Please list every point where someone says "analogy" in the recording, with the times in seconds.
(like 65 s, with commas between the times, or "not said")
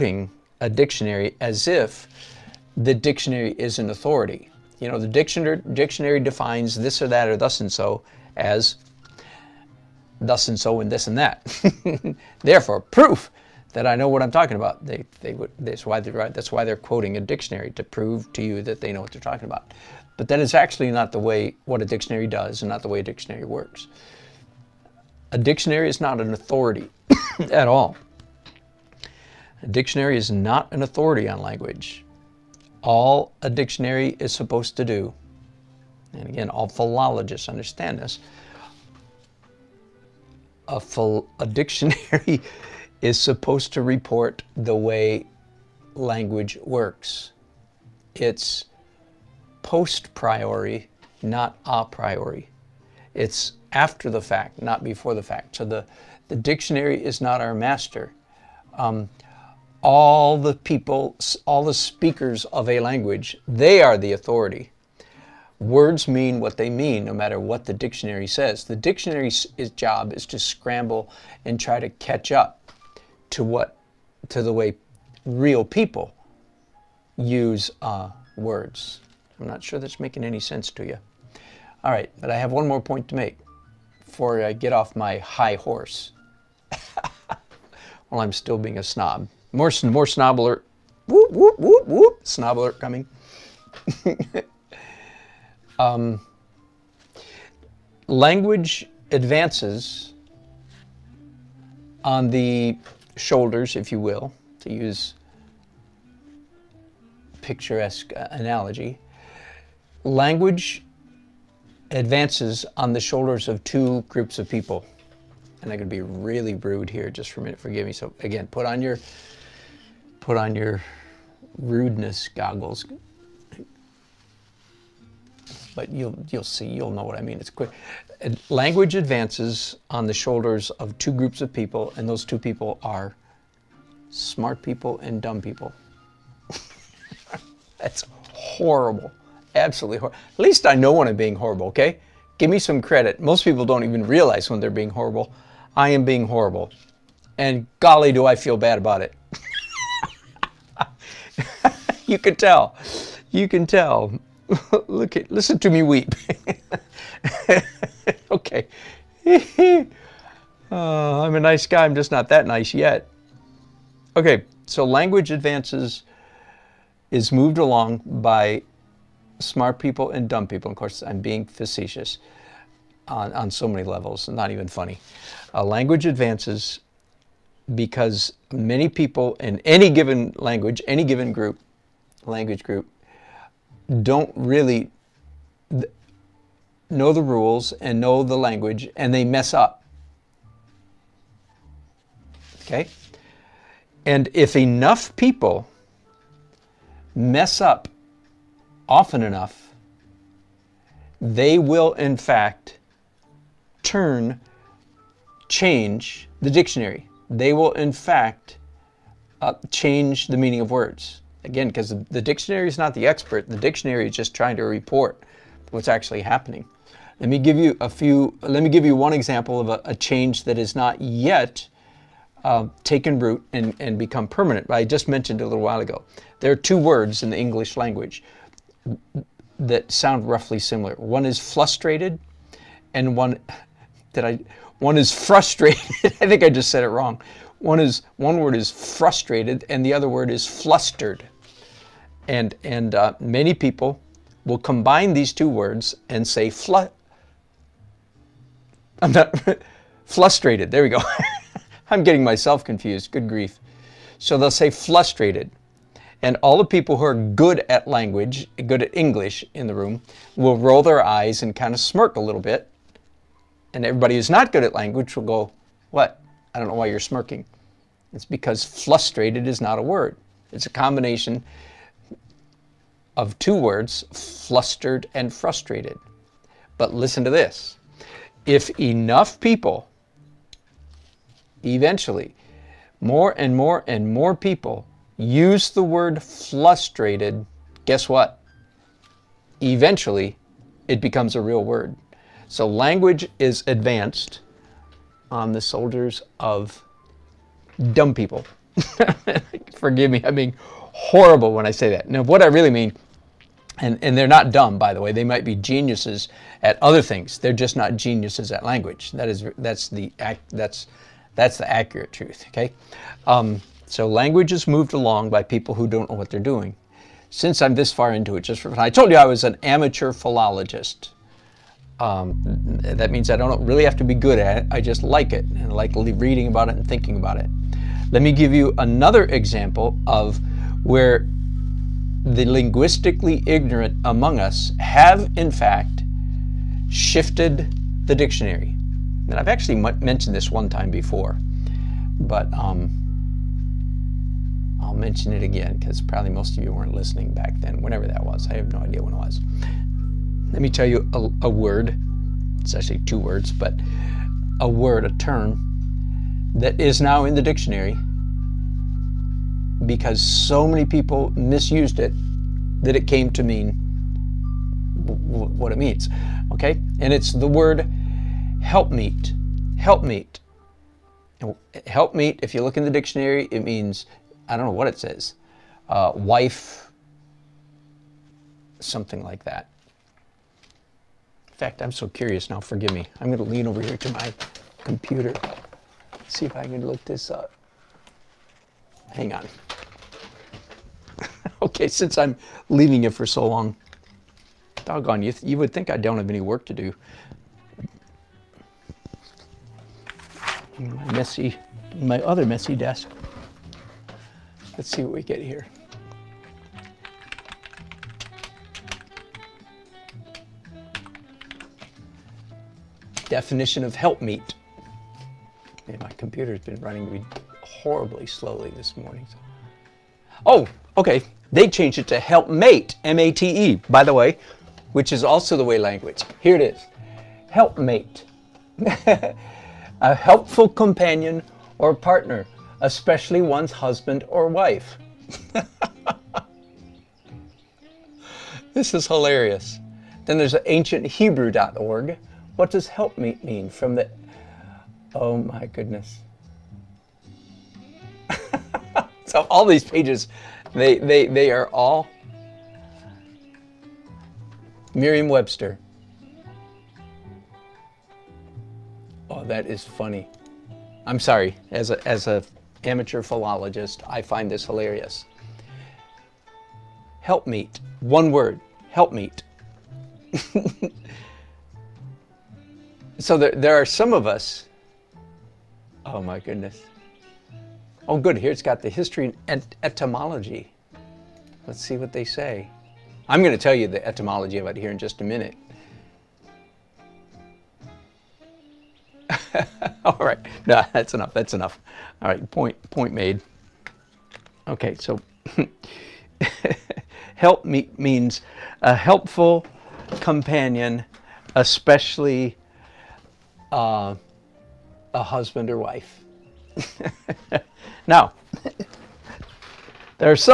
108 s.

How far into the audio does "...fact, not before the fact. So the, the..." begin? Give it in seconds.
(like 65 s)
54 s.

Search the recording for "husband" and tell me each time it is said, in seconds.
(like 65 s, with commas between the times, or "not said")
433 s, 505 s.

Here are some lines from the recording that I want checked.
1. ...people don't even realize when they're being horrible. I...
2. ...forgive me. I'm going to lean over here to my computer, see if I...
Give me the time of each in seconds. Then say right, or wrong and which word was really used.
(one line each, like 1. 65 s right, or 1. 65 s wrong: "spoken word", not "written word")
1. 143 s right
2. 382 s right.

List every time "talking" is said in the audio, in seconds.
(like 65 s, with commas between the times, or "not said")
14 s, 19 s.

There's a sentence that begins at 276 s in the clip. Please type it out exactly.
But listen to this if enough people, eventually, more and more and more people use the word flustrated, guess what?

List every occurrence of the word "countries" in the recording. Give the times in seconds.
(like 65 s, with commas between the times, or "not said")
not said.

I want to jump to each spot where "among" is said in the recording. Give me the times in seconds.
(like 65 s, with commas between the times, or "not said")
334 s.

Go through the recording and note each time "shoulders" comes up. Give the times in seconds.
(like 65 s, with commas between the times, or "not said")
103 s, 113 s, 130 s.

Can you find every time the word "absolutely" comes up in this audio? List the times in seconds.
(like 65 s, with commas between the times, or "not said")
139 s.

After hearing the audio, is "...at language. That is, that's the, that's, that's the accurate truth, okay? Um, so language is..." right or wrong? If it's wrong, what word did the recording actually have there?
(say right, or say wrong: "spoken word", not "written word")
right.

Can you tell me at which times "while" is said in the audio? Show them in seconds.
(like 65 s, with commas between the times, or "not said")
88 s, 225 s.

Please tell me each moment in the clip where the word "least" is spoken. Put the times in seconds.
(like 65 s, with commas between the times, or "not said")
140 s.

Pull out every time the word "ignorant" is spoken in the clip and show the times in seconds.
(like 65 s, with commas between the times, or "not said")
333 s.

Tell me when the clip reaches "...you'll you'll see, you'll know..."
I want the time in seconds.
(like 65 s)
125 s.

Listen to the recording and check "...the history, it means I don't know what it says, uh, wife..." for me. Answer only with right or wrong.
wrong.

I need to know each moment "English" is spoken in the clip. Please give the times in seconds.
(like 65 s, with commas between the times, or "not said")
227 s, 258 s.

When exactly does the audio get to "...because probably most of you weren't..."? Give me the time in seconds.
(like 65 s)
345 s.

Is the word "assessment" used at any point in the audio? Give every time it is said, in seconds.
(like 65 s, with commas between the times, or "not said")
not said.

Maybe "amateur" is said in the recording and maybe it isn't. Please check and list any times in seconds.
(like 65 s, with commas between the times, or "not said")
319 s, 462 s.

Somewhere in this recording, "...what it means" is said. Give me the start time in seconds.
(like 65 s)
364 s.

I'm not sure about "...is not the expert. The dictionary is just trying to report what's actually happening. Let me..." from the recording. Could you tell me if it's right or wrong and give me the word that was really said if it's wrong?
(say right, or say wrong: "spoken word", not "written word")
right.